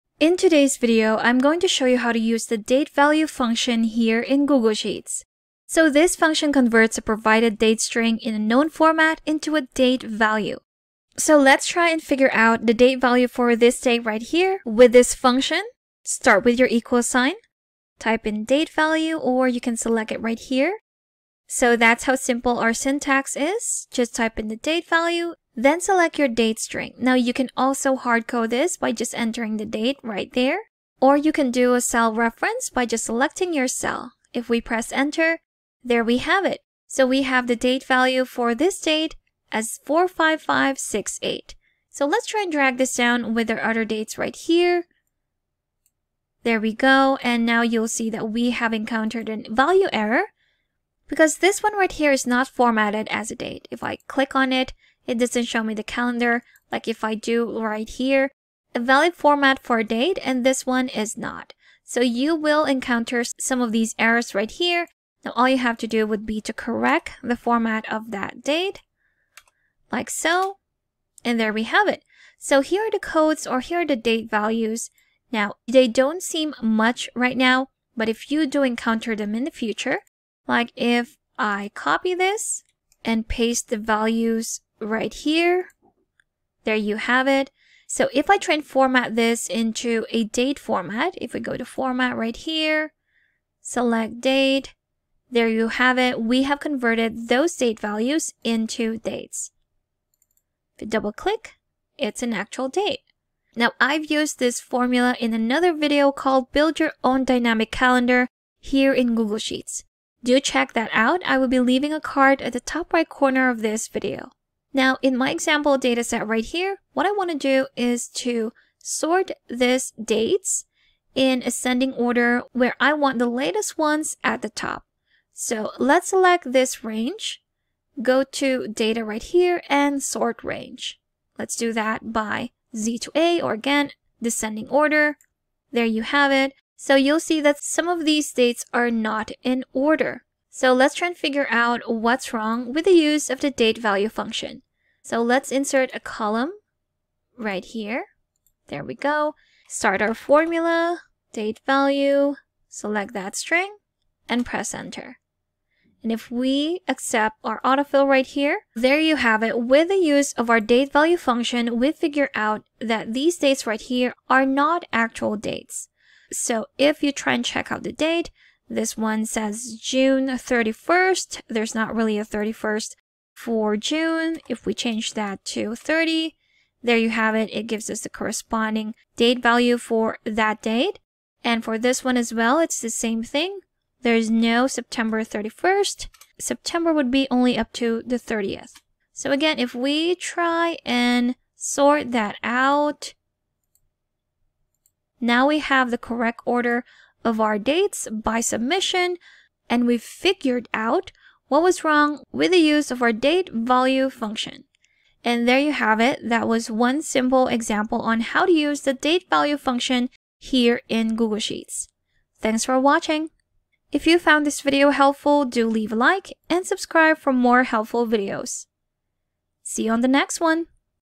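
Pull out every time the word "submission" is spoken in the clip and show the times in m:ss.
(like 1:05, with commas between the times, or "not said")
3:18.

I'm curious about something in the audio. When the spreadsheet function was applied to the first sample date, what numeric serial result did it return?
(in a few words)
45568.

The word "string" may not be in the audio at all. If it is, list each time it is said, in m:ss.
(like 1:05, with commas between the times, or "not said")
0:07, 0:26, 2:33.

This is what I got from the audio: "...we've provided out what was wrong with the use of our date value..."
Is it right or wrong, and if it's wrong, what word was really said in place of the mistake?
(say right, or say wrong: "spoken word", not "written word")
wrong: "figured", not "provided".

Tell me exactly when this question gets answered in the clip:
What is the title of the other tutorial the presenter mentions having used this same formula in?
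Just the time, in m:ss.
1:46.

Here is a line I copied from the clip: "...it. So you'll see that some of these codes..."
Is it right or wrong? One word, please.
wrong.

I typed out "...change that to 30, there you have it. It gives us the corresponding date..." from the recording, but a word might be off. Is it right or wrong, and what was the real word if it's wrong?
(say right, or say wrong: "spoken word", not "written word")
right.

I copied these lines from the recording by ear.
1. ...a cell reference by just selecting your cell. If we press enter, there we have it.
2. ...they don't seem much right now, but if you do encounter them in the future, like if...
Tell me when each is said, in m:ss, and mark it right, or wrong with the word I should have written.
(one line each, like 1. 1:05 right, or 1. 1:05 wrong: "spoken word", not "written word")
1. 0:31 right
2. 1:15 right.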